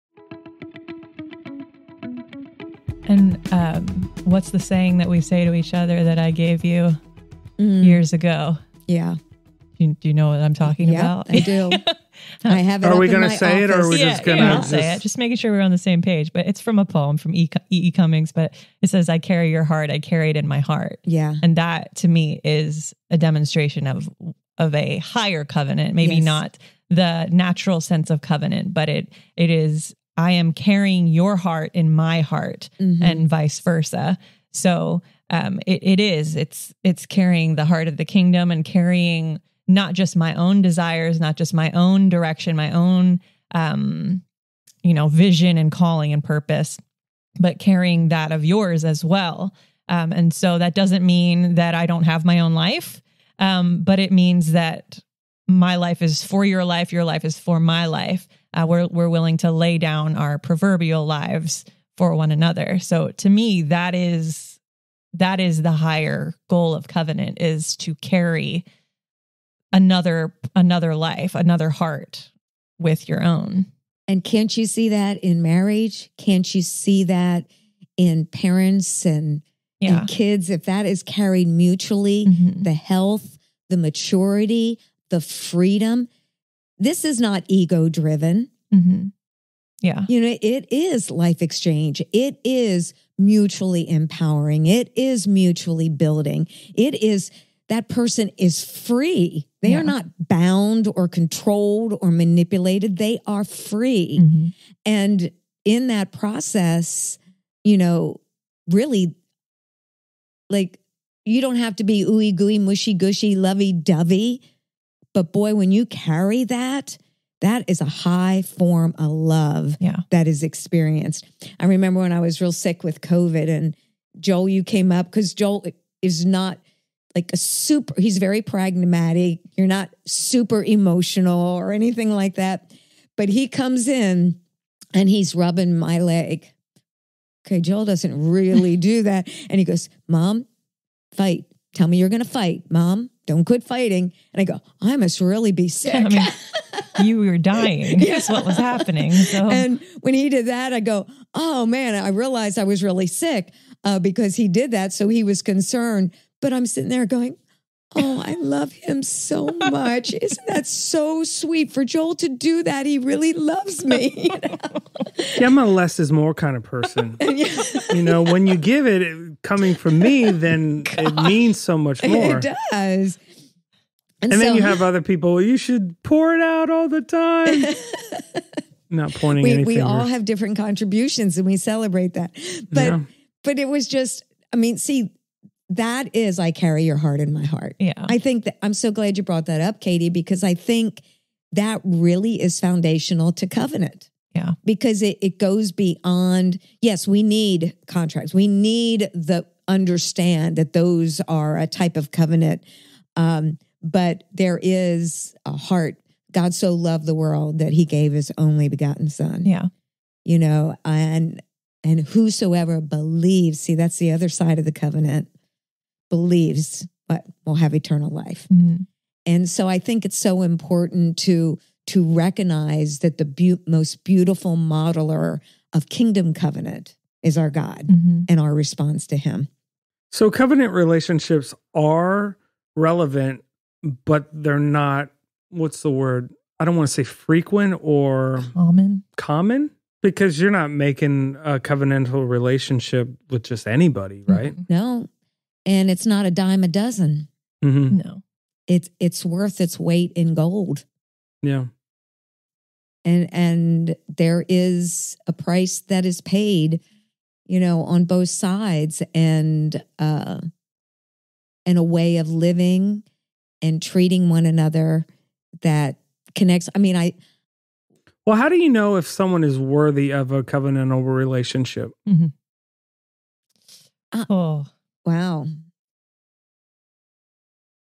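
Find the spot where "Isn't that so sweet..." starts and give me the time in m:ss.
2:40.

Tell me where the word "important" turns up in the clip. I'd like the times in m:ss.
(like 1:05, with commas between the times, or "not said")
3:40.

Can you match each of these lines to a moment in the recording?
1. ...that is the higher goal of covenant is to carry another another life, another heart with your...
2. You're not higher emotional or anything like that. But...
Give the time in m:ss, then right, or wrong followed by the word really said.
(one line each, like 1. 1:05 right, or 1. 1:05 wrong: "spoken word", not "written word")
1. 1:05 right
2. 2:09 wrong: "super", not "higher".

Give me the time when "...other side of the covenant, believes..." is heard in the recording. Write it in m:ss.
3:34.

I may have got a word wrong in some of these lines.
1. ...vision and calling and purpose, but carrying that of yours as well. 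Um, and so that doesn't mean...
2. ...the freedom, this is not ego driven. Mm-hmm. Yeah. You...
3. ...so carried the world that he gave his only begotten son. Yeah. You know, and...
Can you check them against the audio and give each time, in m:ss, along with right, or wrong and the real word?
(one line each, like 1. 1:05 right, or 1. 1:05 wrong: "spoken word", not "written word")
1. 0:45 right
2. 1:25 right
3. 3:26 wrong: "loved", not "carried".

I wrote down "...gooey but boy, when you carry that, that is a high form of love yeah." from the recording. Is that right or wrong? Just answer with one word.
wrong.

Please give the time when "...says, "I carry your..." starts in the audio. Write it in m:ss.
0:18.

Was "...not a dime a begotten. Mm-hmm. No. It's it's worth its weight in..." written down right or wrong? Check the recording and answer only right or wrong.
wrong.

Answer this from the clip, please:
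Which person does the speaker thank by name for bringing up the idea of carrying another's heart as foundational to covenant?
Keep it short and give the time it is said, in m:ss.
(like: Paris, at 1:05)
Katie, at 3:09.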